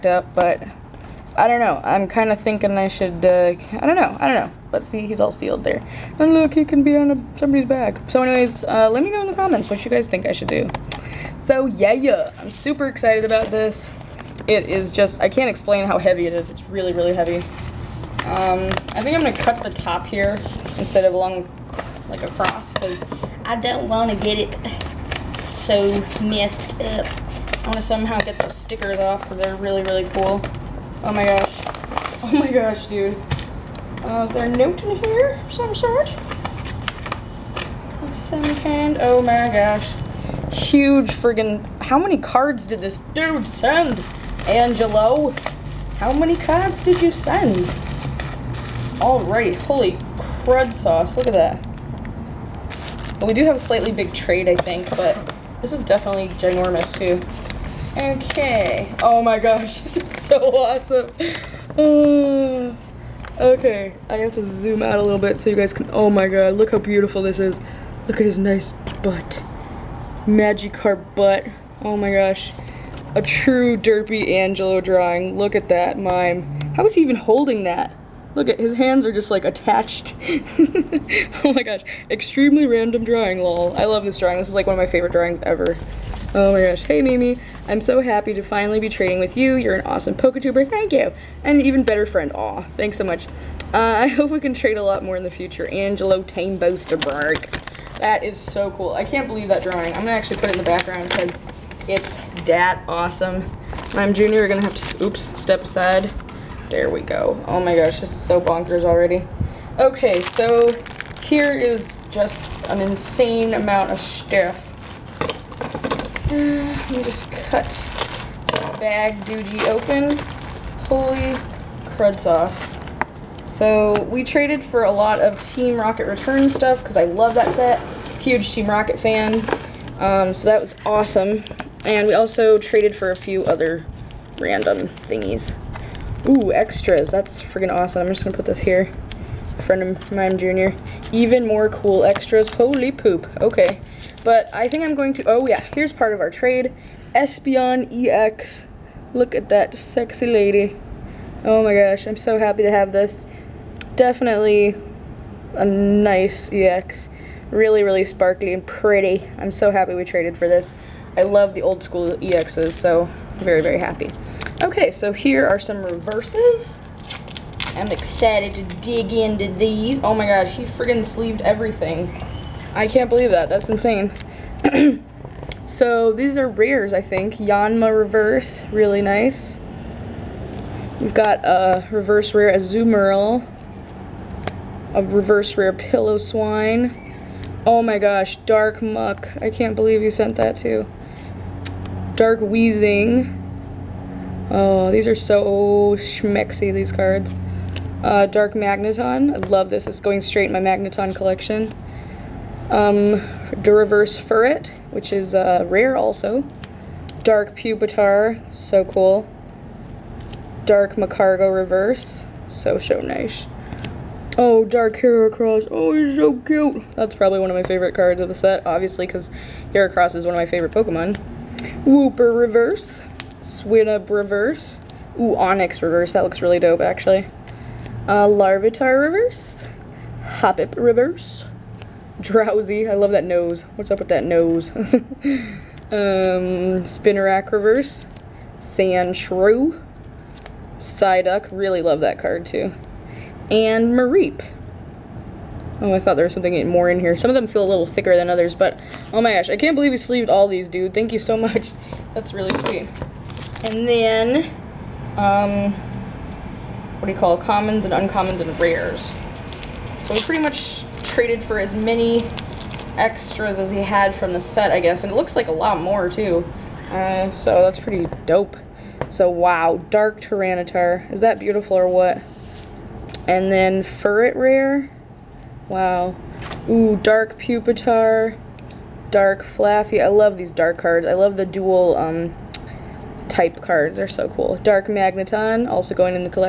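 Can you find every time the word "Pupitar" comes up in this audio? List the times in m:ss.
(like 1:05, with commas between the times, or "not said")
3:27, 4:37.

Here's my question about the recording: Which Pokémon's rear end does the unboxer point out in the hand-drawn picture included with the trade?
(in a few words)
Magikarp.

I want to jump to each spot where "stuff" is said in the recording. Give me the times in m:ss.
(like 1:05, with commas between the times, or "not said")
1:54, 2:06.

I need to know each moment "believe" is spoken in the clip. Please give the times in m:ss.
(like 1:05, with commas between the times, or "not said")
1:39, 2:53, 3:09, 4:09.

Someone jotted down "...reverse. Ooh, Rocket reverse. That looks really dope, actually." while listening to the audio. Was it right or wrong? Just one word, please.
wrong.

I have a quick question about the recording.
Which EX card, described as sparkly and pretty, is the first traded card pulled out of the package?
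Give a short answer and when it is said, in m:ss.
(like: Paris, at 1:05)
Espeon EX, at 2:27.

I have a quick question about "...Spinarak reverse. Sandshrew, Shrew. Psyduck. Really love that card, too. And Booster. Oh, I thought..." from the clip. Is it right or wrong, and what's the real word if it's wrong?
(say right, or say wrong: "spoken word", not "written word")
wrong: "Mareep", not "Booster".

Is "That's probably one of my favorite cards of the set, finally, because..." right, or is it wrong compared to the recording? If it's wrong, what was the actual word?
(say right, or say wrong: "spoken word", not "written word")
wrong: "obviously", not "finally".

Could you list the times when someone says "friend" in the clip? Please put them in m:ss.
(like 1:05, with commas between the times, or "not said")
1:32, 2:19.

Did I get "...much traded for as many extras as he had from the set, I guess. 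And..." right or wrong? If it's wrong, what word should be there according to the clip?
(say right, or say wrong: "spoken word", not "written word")
right.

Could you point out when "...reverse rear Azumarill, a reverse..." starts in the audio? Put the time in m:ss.
3:01.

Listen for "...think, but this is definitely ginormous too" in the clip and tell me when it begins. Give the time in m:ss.
0:54.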